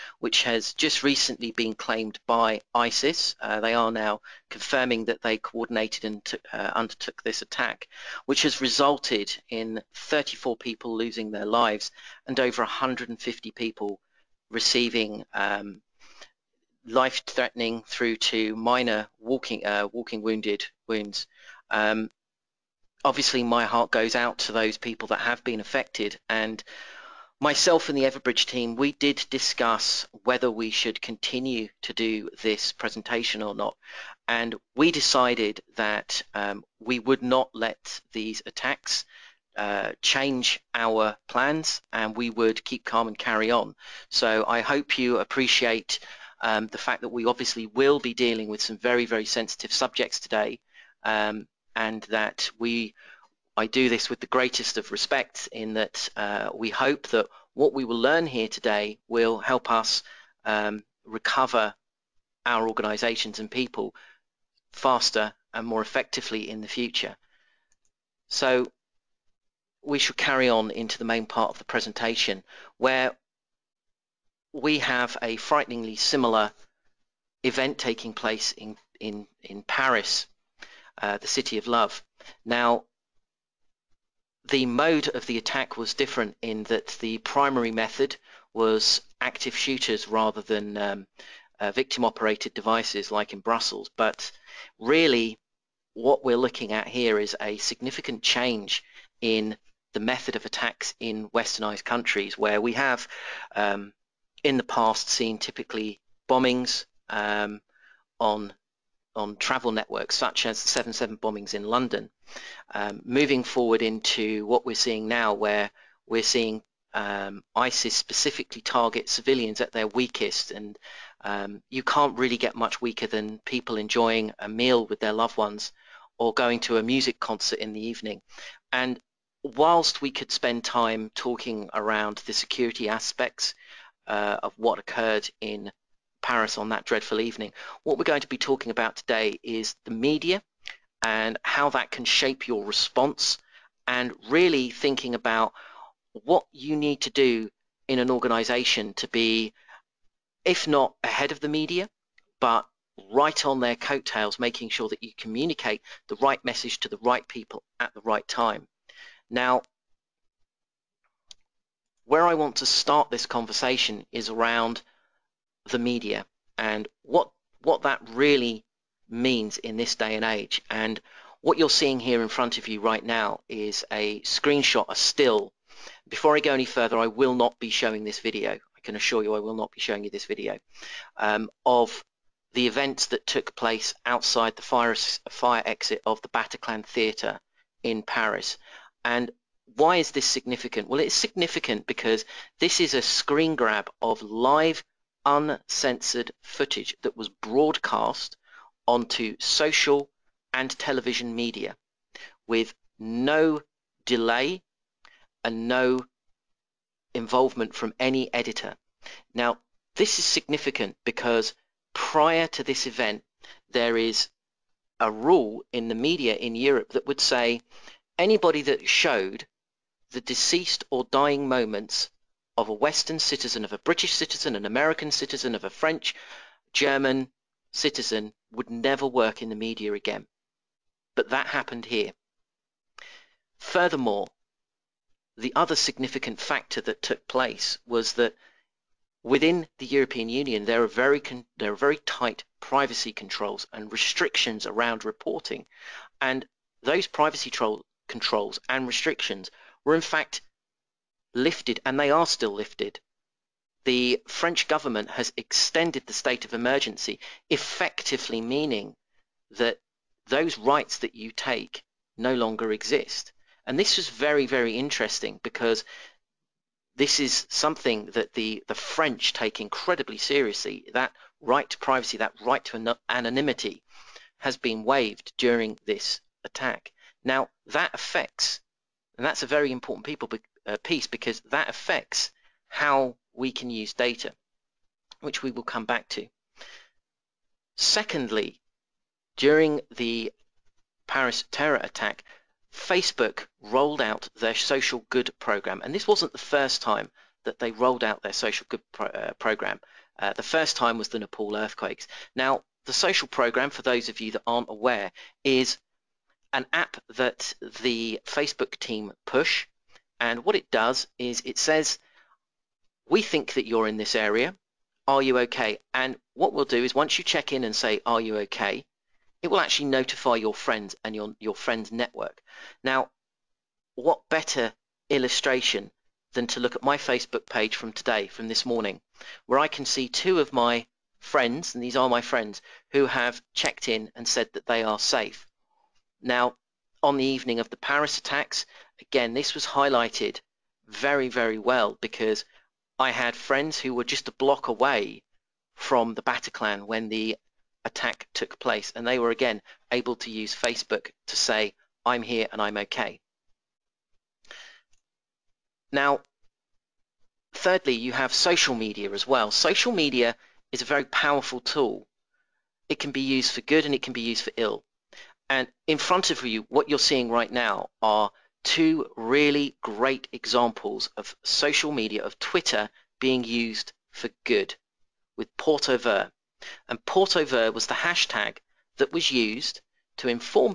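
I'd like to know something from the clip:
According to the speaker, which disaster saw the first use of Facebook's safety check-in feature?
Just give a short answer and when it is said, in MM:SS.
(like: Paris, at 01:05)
Nepal earthquakes, at 05:01.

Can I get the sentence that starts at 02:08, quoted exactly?
And whilst we could spend time talking around the security aspects, uh, of what occurred in Paris on that dreadful evening.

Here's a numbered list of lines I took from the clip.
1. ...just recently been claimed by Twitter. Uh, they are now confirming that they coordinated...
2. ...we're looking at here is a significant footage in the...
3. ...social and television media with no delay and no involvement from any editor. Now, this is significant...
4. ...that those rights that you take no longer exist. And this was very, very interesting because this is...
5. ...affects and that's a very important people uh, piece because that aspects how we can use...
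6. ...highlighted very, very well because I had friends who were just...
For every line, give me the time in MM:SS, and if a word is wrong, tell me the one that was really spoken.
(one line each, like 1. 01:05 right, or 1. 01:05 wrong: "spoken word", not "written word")
1. 00:00 wrong: "ISIS", not "Twitter"
2. 01:36 wrong: "change", not "footage"
3. 03:19 right
4. 04:19 right
5. 04:37 wrong: "affects", not "aspects"
6. 05:39 right.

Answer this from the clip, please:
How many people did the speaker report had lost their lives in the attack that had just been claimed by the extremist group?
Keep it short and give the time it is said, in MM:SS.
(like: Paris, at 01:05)
34, at 00:09.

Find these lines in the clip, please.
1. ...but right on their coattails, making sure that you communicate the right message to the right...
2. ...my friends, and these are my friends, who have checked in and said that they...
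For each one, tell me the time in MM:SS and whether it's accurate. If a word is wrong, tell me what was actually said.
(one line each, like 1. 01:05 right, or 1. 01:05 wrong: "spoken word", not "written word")
1. 02:32 right
2. 05:30 right.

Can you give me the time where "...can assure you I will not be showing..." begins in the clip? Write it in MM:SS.
02:58.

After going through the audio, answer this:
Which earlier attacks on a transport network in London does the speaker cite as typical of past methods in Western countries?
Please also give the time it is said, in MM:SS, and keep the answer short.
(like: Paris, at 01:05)
7-7 bombings, at 01:50.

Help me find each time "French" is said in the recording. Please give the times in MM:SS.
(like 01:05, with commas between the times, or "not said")
03:45, 04:14, 04:28.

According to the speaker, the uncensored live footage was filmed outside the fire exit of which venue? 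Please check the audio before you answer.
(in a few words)
Bataclan Theatre.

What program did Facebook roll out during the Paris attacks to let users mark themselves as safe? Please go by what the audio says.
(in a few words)
social good program.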